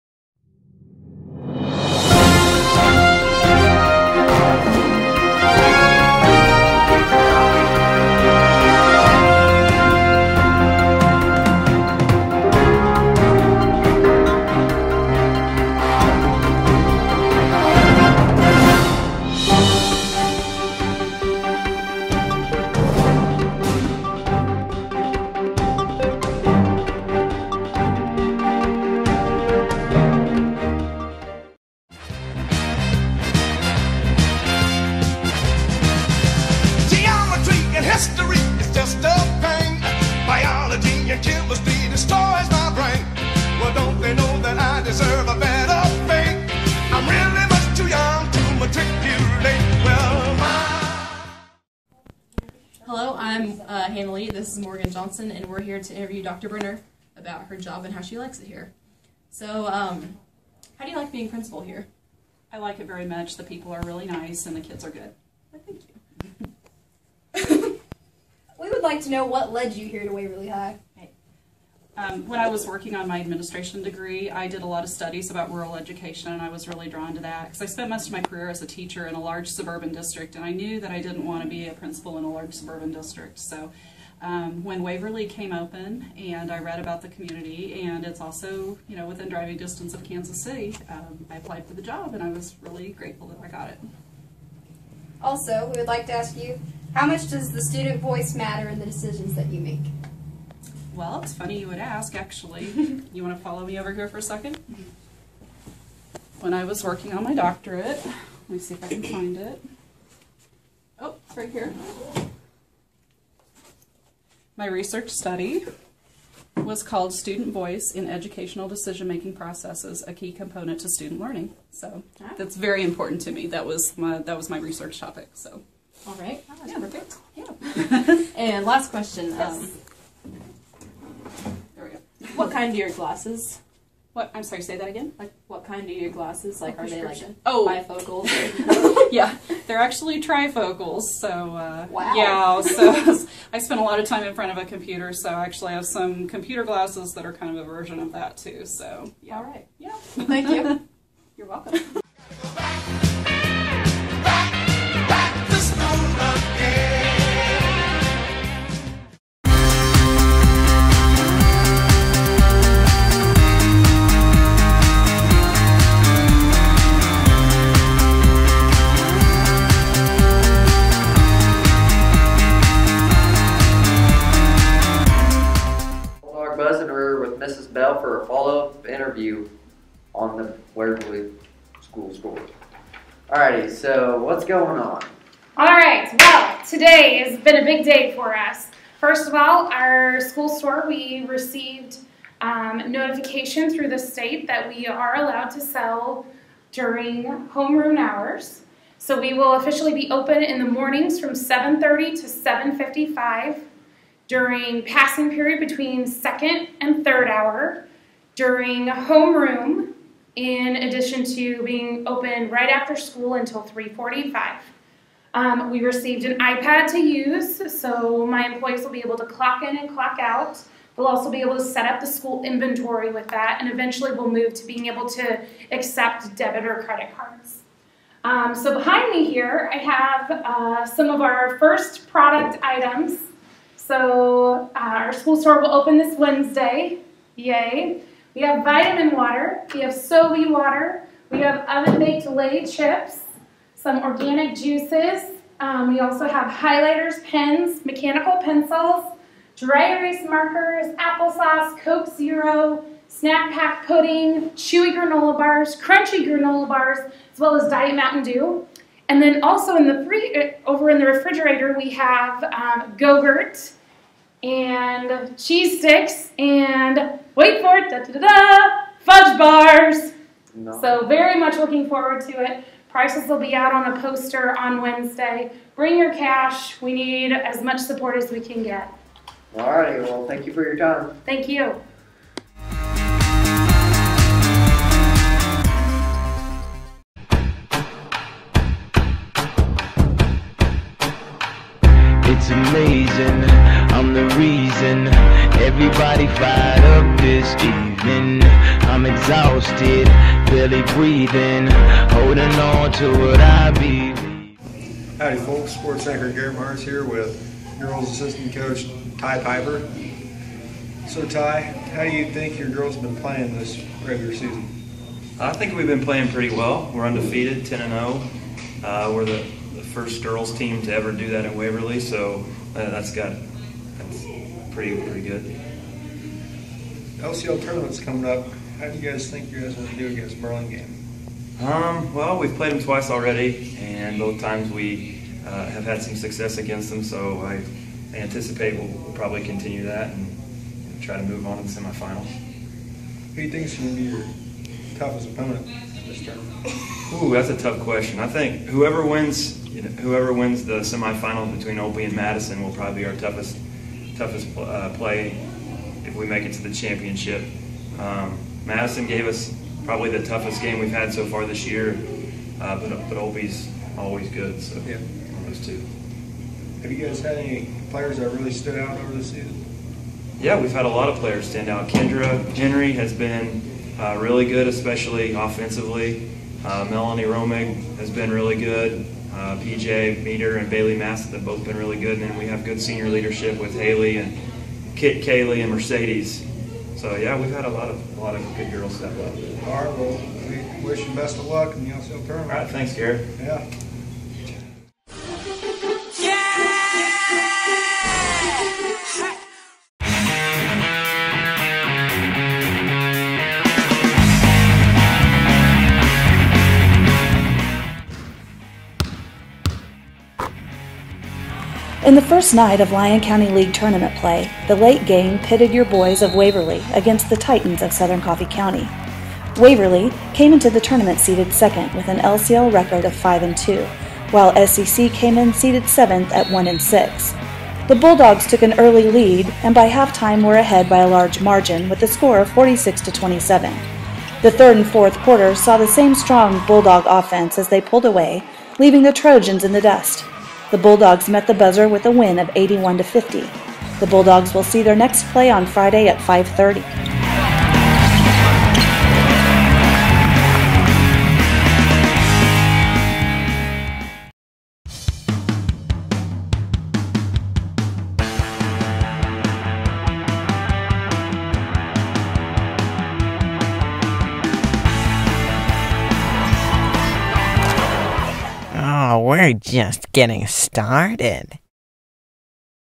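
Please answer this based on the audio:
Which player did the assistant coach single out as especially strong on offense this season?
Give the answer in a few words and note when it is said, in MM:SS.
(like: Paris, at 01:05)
Kendra Henry, at 06:11.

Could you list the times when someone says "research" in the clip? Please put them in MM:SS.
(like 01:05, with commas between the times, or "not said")
01:54, 02:04.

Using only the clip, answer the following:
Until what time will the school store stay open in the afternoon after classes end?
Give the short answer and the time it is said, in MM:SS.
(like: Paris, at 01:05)
3:45, at 03:33.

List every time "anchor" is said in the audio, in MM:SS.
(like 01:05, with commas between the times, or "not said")
05:06.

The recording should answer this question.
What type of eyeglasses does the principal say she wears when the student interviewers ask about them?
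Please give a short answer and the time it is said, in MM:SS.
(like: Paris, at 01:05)
Trifocals, at 02:20.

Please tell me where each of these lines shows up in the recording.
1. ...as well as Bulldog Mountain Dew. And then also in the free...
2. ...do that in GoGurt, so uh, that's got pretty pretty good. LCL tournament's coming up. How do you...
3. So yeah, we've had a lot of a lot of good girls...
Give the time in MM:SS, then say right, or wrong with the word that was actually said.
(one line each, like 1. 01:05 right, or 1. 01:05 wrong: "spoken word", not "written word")
1. 04:17 wrong: "Diet", not "Bulldog"
2. 05:21 wrong: "Waverly", not "GoGurt"
3. 06:26 right.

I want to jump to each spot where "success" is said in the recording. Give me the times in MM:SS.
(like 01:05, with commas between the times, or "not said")
05:36.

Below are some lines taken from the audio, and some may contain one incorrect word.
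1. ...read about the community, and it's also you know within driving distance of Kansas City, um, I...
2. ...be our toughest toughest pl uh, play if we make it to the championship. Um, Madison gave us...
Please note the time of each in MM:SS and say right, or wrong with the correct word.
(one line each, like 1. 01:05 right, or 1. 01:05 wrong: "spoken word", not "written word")
1. 01:26 right
2. 05:53 right.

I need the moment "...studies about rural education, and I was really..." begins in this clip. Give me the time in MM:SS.
01:14.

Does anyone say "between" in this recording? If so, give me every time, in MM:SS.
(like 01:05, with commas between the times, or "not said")
03:25, 05:51.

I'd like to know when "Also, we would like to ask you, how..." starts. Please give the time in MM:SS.
01:35.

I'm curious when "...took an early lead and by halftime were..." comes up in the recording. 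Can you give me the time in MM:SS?
07:08.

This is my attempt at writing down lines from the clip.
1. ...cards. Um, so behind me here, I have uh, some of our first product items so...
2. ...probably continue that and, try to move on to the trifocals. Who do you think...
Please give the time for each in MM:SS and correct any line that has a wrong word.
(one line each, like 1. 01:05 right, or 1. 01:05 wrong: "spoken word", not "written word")
1. 03:47 right
2. 05:39 wrong: "semifinals", not "trifocals".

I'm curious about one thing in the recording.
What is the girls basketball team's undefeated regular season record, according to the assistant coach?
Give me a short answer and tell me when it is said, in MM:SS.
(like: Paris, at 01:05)
10 and 0, at 05:17.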